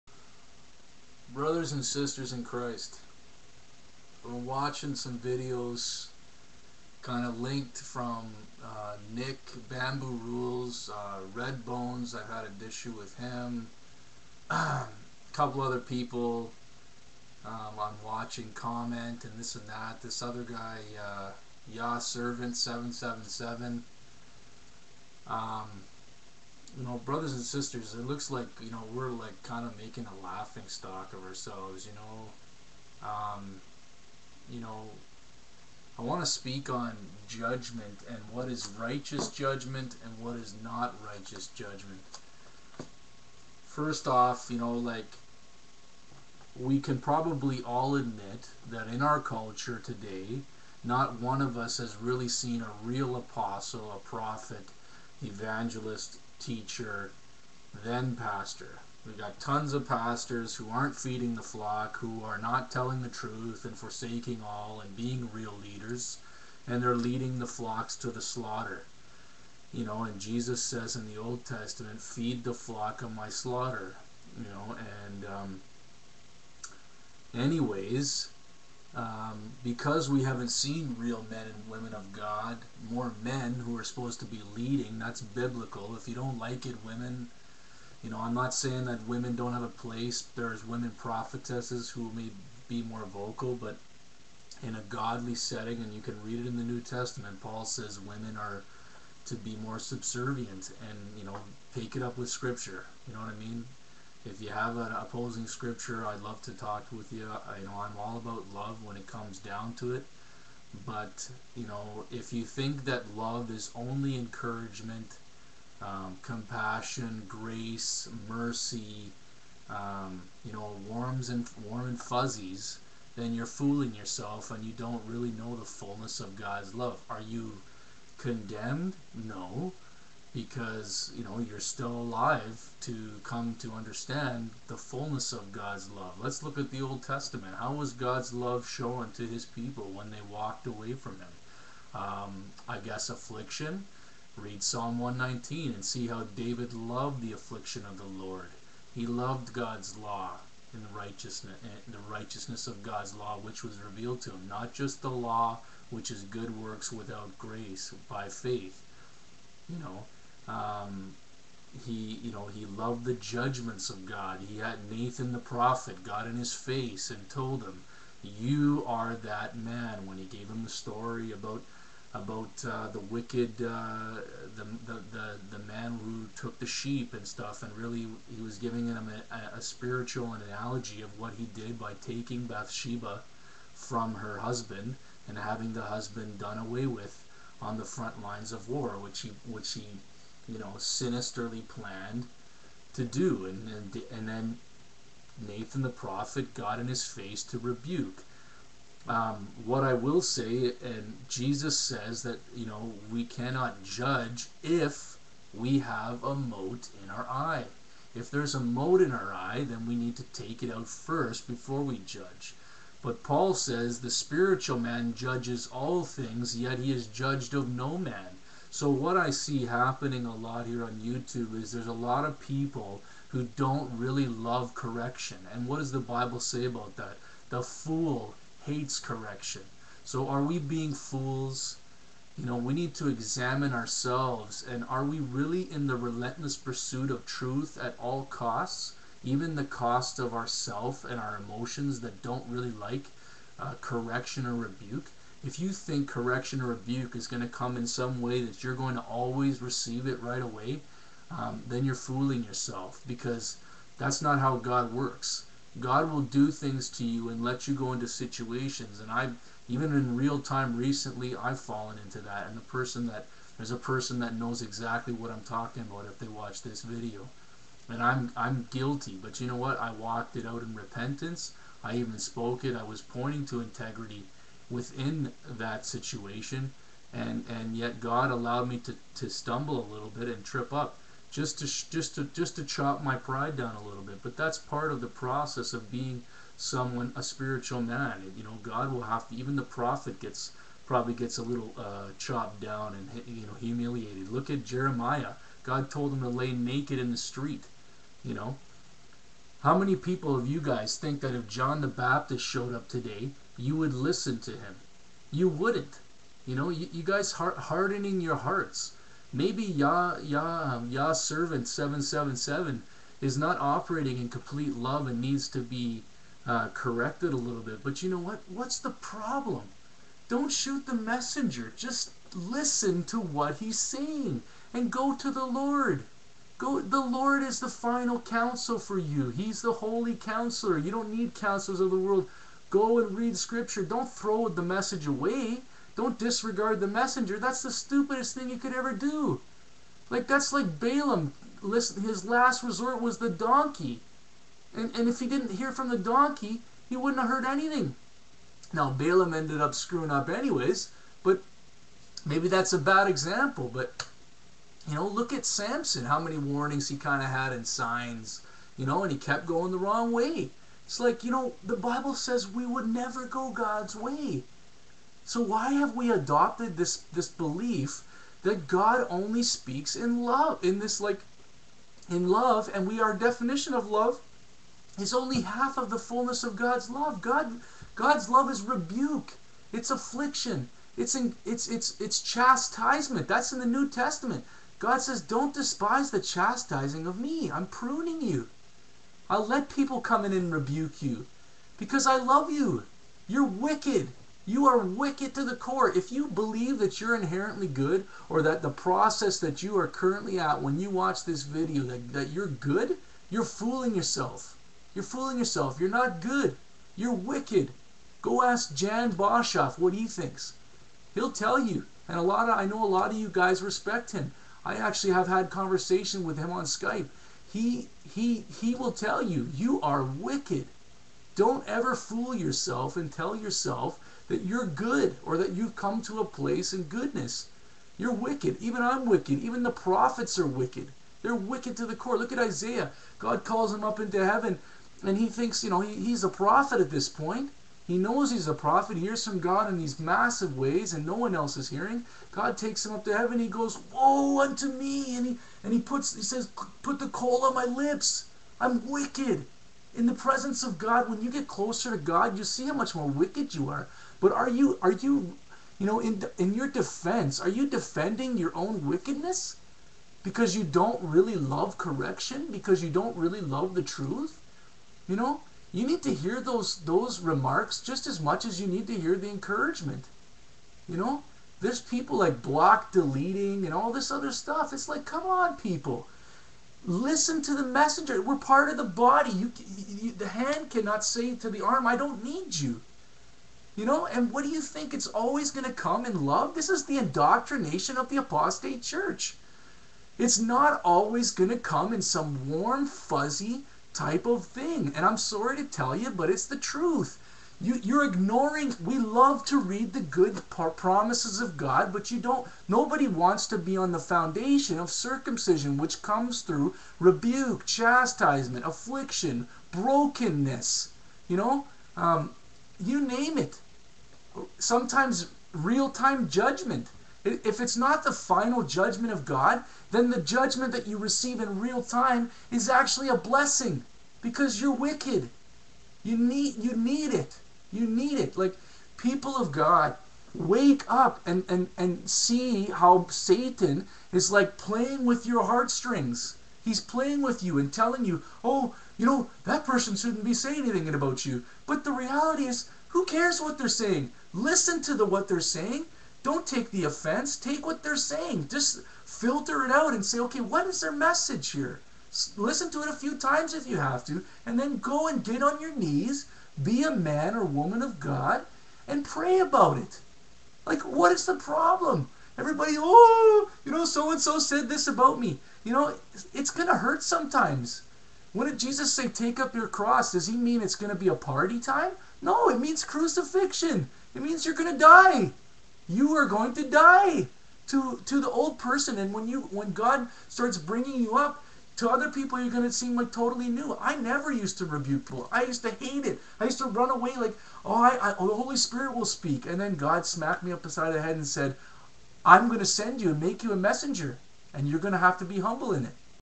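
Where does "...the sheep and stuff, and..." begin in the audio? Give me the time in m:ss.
2:56.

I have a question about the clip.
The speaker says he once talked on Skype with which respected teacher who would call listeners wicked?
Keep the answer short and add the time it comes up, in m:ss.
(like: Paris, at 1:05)
Jan Boshoff, at 6:48.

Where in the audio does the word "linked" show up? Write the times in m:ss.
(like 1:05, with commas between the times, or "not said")
0:07.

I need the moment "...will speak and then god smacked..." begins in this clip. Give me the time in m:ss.
9:48.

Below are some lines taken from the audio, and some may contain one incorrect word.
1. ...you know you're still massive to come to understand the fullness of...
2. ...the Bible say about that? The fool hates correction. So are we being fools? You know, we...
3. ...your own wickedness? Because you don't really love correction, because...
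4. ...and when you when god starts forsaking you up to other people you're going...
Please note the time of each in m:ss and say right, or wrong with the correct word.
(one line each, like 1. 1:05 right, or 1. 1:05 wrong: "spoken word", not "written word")
1. 2:11 wrong: "alive", not "massive"
2. 3:45 right
3. 7:38 right
4. 9:38 wrong: "bringing", not "forsaking".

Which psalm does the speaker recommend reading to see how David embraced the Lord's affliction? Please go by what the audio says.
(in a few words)
Psalm 119.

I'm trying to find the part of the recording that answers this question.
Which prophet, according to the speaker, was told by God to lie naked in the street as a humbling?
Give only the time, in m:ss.
4:54.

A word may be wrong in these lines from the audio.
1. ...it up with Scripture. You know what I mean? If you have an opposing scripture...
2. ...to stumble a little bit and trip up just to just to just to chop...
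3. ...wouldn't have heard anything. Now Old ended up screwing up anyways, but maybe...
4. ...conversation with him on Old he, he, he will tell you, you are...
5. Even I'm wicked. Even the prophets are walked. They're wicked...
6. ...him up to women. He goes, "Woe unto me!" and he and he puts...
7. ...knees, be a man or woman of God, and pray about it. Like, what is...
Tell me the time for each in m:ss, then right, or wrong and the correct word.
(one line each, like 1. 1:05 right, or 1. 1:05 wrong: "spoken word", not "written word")
1. 1:41 right
2. 4:39 right
3. 5:46 wrong: "Balaam", not "Old"
4. 6:55 wrong: "Skype", not "Old"
5. 7:08 wrong: "wicked", not "walked"
6. 7:22 wrong: "heaven", not "women"
7. 9:15 right.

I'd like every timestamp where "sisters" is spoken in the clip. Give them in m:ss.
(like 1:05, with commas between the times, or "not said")
0:01, 0:27.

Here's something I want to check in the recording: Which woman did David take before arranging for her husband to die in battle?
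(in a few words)
Bathsheba.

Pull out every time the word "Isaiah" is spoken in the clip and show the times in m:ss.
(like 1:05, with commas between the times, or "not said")
7:12.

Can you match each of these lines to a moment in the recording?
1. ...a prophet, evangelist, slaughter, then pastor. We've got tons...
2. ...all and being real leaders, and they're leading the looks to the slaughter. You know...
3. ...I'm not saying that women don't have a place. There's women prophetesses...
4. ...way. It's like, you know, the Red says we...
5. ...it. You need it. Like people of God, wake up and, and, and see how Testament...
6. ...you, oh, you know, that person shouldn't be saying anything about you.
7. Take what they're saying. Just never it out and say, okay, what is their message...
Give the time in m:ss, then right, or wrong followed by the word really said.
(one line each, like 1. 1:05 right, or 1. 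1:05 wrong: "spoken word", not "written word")
1. 0:53 wrong: "teacher", not "slaughter"
2. 1:04 wrong: "flocks", not "looks"
3. 1:28 right
4. 6:00 wrong: "Bible", not "Red"
5. 8:47 wrong: "Satan", not "Testament"
6. 8:58 right
7. 9:07 wrong: "filter", not "never".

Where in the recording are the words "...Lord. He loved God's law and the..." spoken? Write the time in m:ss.
2:28.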